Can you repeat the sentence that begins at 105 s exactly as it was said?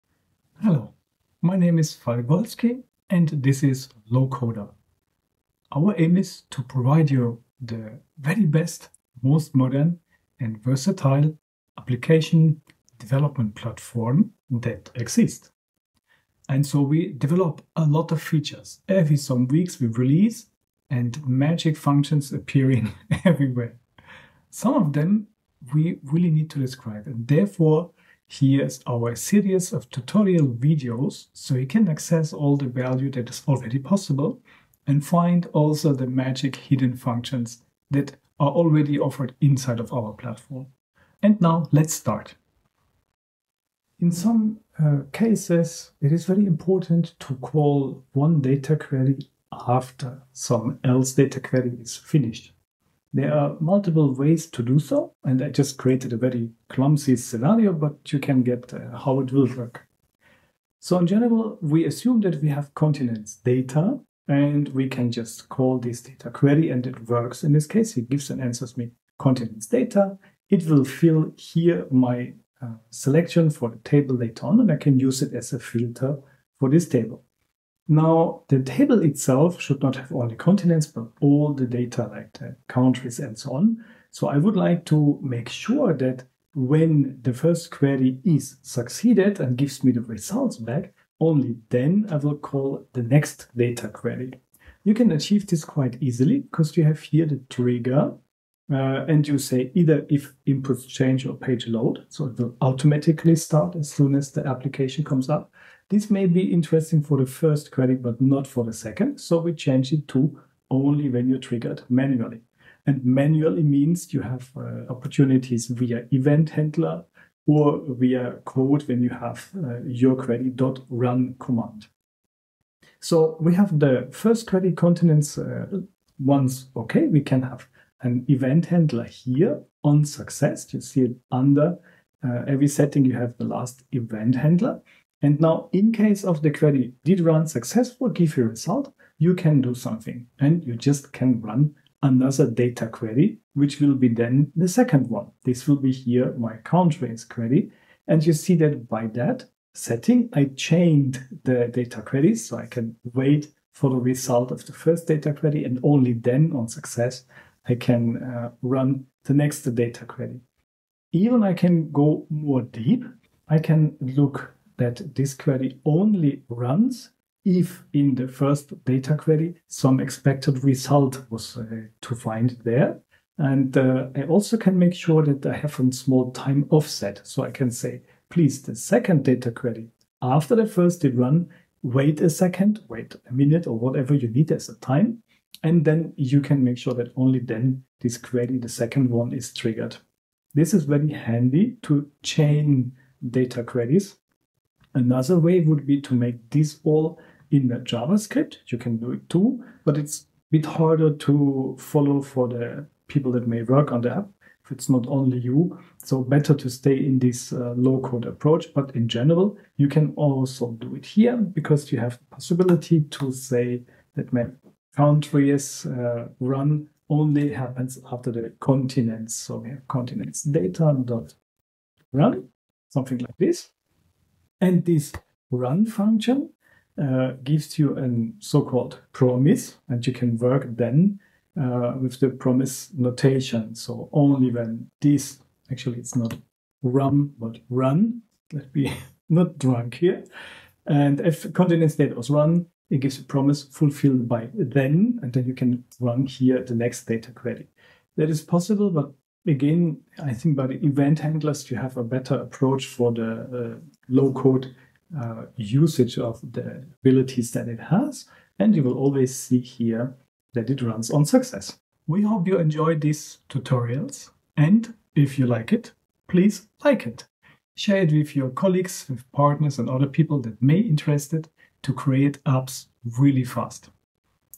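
This may be interesting for the first query, but not for the second.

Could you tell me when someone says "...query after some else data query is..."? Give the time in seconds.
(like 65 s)
48 s.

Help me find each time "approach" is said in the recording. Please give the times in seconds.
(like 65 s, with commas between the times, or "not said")
208 s, 252 s.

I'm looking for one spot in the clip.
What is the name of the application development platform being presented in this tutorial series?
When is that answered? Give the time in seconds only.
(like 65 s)
4 s.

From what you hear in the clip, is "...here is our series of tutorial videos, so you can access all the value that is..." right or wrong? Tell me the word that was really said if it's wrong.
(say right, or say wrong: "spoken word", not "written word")
right.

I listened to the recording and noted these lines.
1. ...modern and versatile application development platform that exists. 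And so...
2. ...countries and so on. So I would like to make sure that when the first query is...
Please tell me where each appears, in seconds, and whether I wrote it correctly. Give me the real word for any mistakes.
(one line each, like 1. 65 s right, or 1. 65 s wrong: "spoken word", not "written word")
1. 9 s right
2. 82 s right.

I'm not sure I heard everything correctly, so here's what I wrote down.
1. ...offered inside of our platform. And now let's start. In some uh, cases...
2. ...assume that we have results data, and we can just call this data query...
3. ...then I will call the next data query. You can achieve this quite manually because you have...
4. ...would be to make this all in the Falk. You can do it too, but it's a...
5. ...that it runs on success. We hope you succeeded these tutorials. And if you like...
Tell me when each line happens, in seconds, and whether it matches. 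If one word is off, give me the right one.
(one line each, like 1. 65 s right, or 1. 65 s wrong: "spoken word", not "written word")
1. 38 s right
2. 61 s wrong: "continents", not "results"
3. 91 s wrong: "easily", not "manually"
4. 195 s wrong: "JavaScript", not "Falk"
5. 260 s wrong: "enjoyed", not "succeeded".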